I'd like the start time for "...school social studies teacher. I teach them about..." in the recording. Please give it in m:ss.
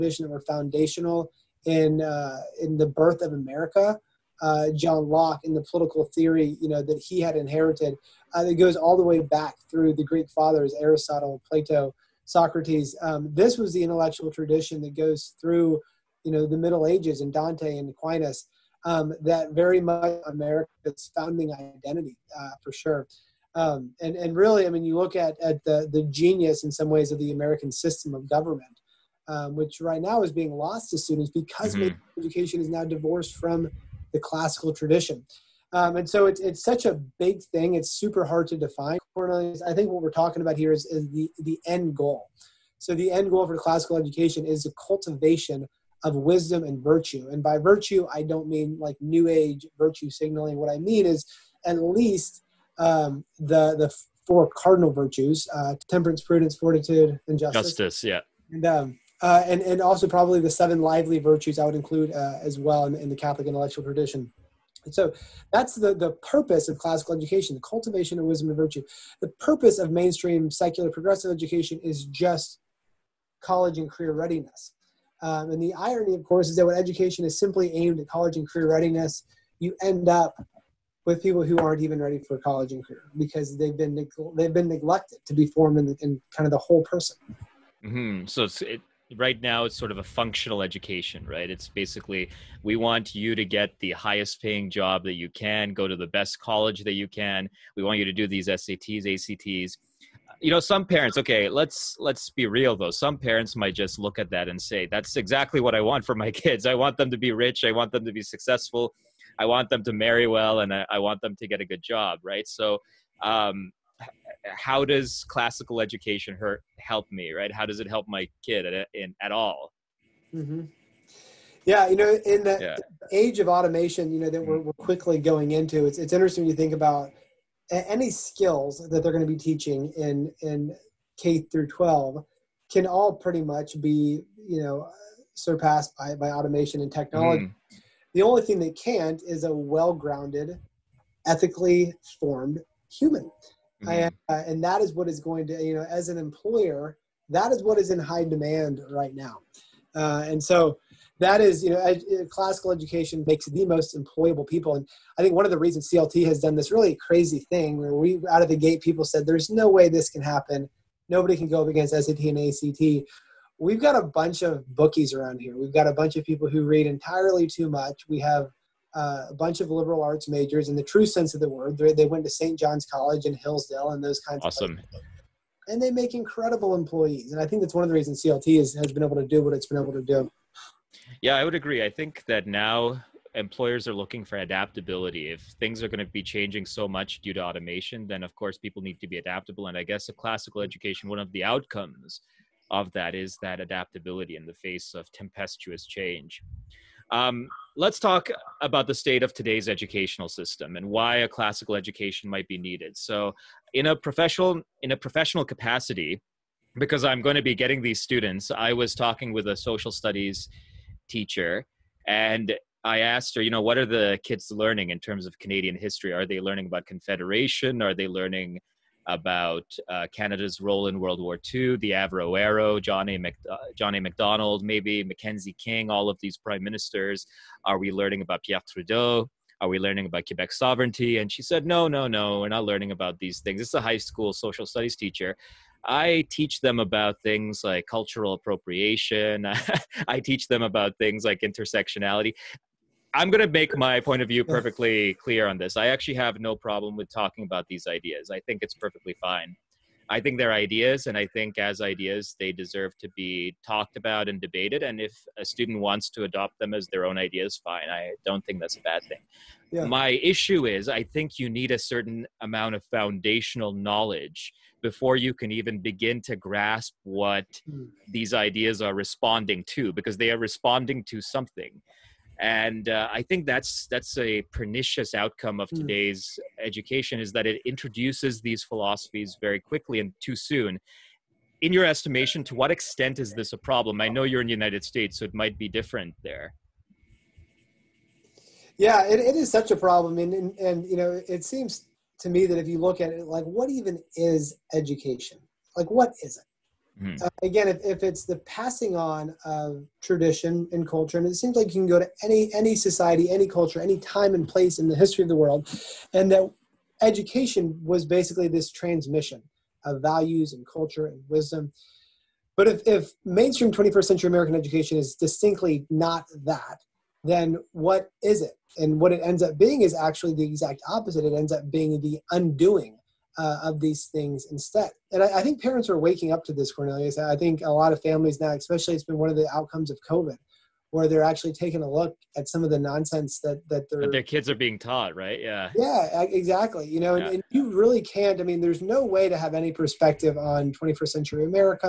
3:53.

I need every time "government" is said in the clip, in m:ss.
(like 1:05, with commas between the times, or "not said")
0:28.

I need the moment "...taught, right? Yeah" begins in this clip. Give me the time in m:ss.
5:34.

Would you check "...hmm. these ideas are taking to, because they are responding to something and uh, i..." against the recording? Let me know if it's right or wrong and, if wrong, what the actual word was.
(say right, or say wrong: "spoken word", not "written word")
wrong: "responding", not "taking".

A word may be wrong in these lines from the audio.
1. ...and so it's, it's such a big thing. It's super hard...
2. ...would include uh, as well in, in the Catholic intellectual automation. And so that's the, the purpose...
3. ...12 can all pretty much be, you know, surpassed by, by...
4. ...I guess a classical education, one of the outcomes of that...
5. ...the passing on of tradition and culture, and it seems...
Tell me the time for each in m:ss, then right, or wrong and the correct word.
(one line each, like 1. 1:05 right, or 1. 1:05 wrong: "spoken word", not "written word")
1. 0:35 right
2. 1:01 wrong: "tradition", not "automation"
3. 2:11 right
4. 3:09 right
5. 4:58 right.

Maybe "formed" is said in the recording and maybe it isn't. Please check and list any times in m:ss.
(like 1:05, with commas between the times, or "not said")
1:25, 2:22.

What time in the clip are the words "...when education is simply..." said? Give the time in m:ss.
1:16.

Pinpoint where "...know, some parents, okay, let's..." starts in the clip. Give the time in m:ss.
1:40.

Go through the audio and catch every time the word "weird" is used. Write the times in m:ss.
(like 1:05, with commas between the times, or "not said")
not said.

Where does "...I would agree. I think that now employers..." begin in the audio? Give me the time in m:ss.
3:01.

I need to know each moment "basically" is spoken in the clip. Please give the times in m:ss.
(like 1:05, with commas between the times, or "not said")
1:31, 5:08.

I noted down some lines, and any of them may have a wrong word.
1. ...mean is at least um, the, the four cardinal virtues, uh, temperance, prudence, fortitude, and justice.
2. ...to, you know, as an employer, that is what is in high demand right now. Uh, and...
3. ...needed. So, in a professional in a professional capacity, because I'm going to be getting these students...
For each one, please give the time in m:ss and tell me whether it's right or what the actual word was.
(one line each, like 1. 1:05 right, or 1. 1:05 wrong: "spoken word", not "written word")
1. 0:50 right
2. 2:25 right
3. 3:22 right.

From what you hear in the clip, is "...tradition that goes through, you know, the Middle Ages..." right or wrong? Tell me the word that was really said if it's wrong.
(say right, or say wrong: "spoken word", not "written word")
right.